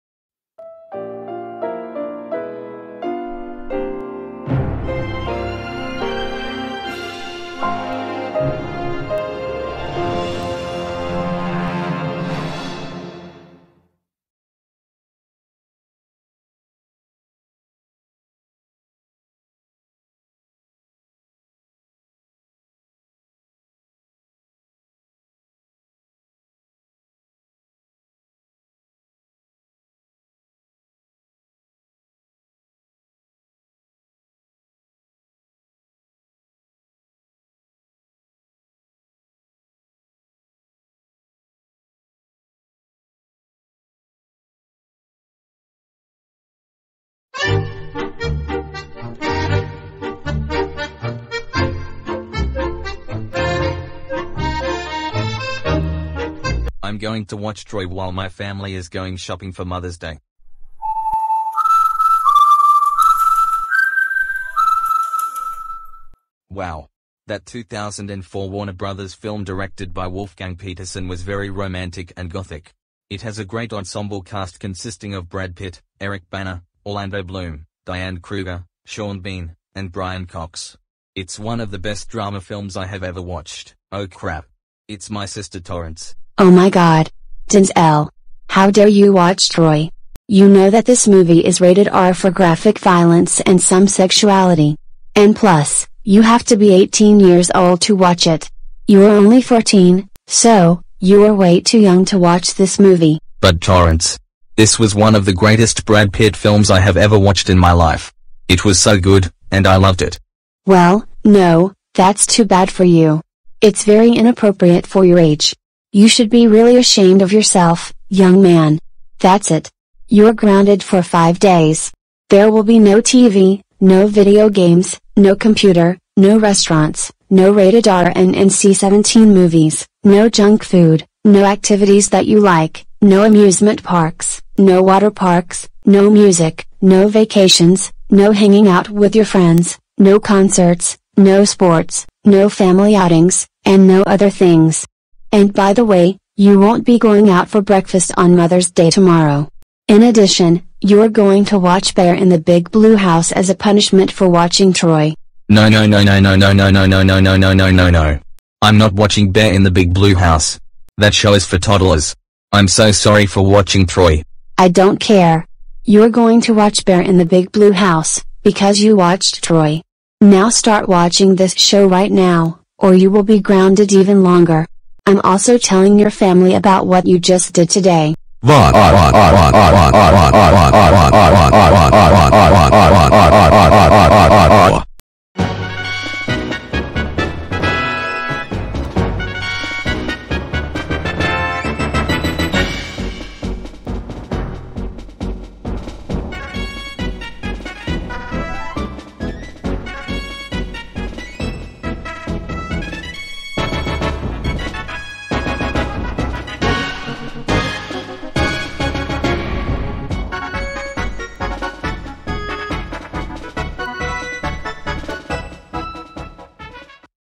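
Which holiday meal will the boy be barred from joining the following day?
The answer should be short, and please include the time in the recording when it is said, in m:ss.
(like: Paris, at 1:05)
Breakfast, at 2:27.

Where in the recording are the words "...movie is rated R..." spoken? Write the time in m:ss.
1:31.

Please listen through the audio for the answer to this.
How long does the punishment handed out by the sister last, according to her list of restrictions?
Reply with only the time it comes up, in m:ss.
2:01.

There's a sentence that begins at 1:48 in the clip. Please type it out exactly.
It was so good, and I loved it.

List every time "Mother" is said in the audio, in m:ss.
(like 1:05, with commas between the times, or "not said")
0:59, 2:28.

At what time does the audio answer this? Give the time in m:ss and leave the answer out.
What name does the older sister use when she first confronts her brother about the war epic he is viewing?
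1:27.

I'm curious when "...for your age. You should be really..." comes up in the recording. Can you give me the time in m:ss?
1:54.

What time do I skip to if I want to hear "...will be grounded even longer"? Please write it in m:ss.
2:53.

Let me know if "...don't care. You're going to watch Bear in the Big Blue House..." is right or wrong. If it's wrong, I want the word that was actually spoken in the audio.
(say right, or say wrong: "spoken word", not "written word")
right.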